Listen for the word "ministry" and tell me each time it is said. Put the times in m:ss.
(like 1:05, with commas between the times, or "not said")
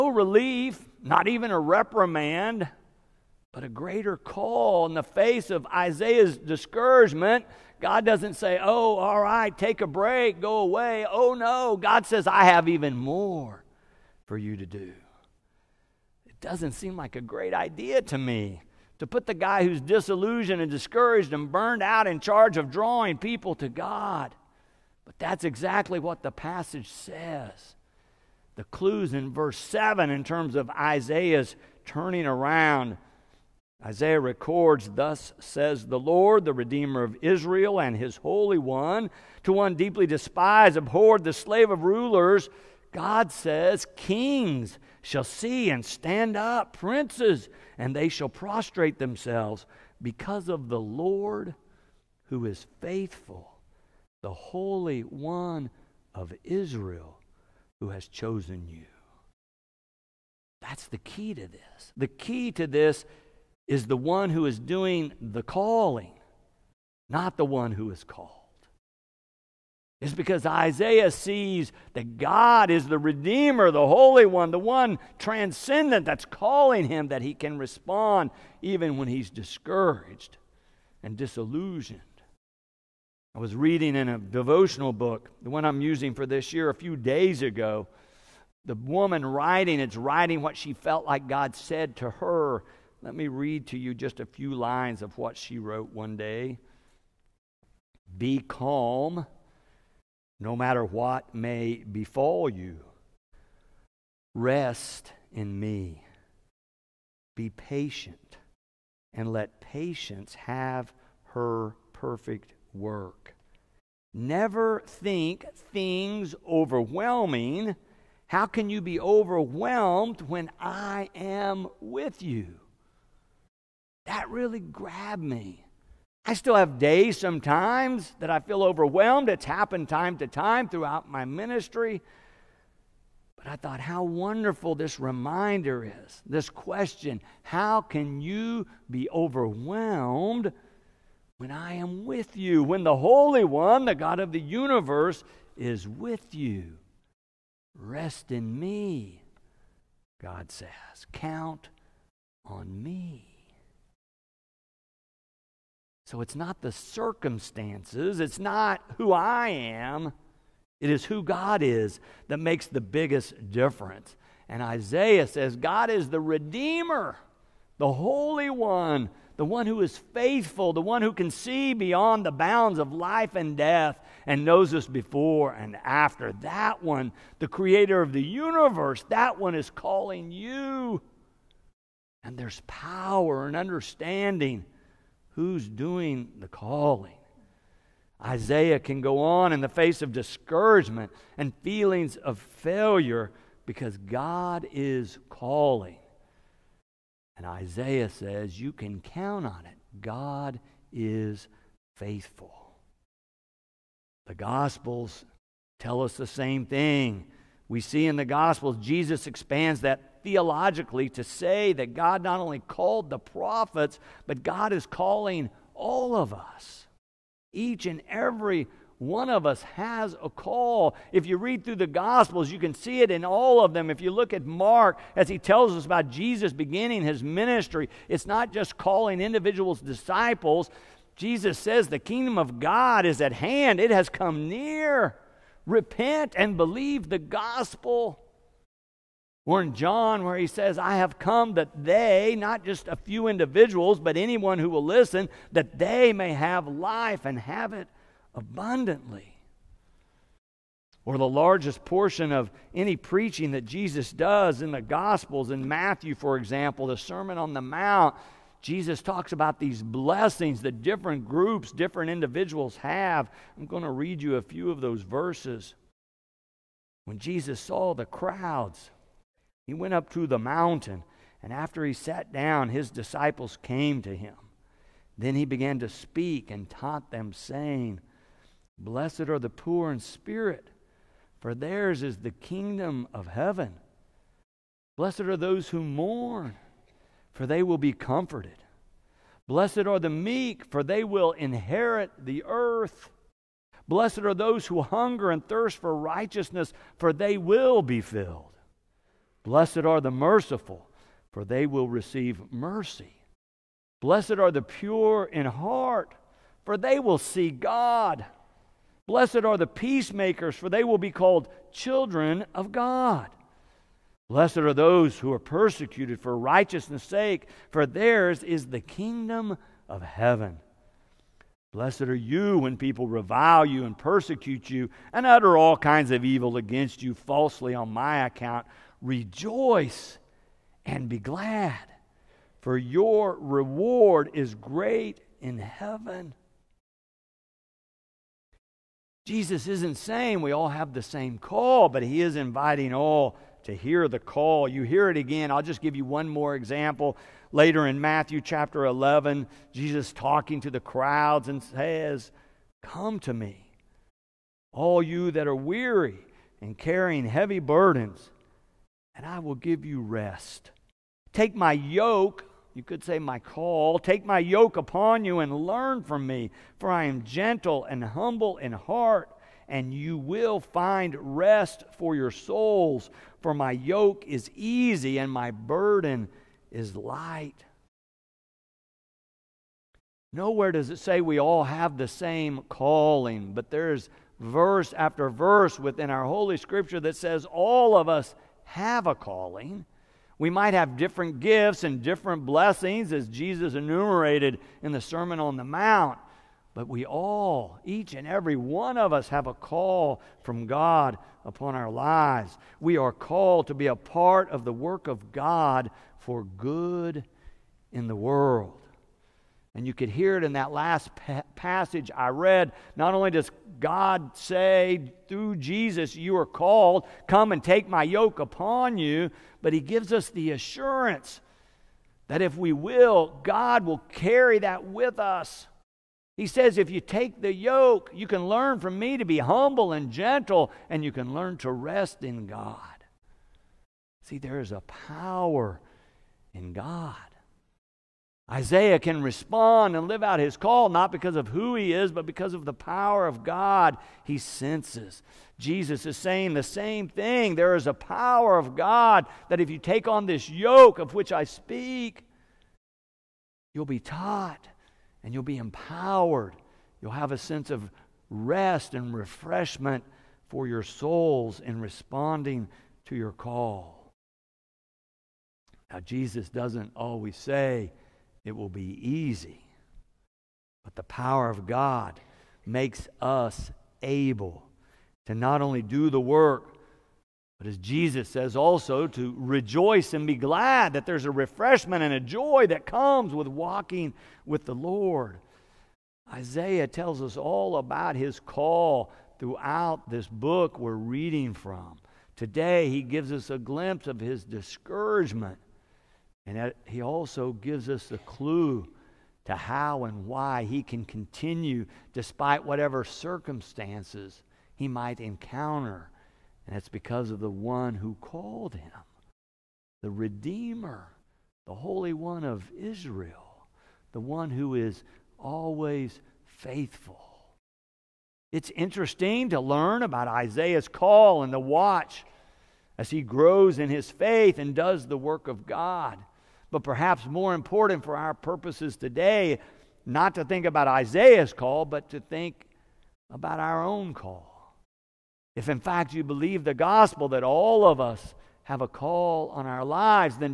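2:11, 3:47.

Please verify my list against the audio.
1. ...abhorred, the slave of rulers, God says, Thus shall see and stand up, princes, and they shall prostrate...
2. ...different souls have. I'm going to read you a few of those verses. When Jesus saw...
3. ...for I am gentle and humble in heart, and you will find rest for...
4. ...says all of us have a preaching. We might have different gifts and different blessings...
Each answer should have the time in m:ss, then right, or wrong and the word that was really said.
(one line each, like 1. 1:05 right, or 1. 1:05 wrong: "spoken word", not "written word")
1. 0:40 wrong: "Kings", not "Thus"
2. 4:21 wrong: "individuals", not "souls"
3. 6:06 right
4. 6:27 wrong: "calling", not "preaching".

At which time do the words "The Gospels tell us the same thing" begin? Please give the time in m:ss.
3:24.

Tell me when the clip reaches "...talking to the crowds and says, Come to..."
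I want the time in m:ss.
5:50.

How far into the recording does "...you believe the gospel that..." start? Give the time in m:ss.
8:56.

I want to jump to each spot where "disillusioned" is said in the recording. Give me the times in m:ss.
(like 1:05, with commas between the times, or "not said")
0:19, 1:21.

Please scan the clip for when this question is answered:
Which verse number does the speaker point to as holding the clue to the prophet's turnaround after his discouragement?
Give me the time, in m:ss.
0:29.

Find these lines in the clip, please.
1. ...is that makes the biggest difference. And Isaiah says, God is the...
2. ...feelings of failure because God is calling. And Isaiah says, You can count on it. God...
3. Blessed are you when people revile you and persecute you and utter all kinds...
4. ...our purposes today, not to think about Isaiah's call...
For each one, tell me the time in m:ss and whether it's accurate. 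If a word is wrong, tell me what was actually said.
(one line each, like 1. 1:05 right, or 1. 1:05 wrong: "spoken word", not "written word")
1. 2:41 right
2. 3:11 right
3. 5:21 right
4. 8:48 right.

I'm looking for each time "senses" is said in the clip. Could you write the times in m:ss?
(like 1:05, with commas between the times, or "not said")
7:24, 7:37.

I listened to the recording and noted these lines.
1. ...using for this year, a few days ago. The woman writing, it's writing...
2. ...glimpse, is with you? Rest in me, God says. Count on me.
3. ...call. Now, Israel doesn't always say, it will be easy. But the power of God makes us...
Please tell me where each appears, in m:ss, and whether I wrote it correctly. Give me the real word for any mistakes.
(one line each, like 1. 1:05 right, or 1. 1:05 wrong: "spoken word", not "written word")
1. 1:25 right
2. 2:24 wrong: "universe", not "glimpse"
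3. 7:43 wrong: "Jesus", not "Israel".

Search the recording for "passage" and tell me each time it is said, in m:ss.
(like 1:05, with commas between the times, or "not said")
0:26, 6:51.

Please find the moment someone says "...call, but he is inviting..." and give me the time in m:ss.
5:41.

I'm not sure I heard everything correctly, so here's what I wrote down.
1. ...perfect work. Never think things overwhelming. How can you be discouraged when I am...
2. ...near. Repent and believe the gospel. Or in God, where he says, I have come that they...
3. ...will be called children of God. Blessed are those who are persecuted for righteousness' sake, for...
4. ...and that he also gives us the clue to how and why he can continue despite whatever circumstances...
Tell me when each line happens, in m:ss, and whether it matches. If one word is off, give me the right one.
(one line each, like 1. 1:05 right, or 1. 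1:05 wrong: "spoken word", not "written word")
1. 1:51 wrong: "overwhelmed", not "discouraged"
2. 3:54 wrong: "John", not "God"
3. 5:10 right
4. 8:16 right.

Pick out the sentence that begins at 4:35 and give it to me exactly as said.
Then he began to speak and taught them, saying, Blessed are the poor in spirit, for theirs is the kingdom of heaven.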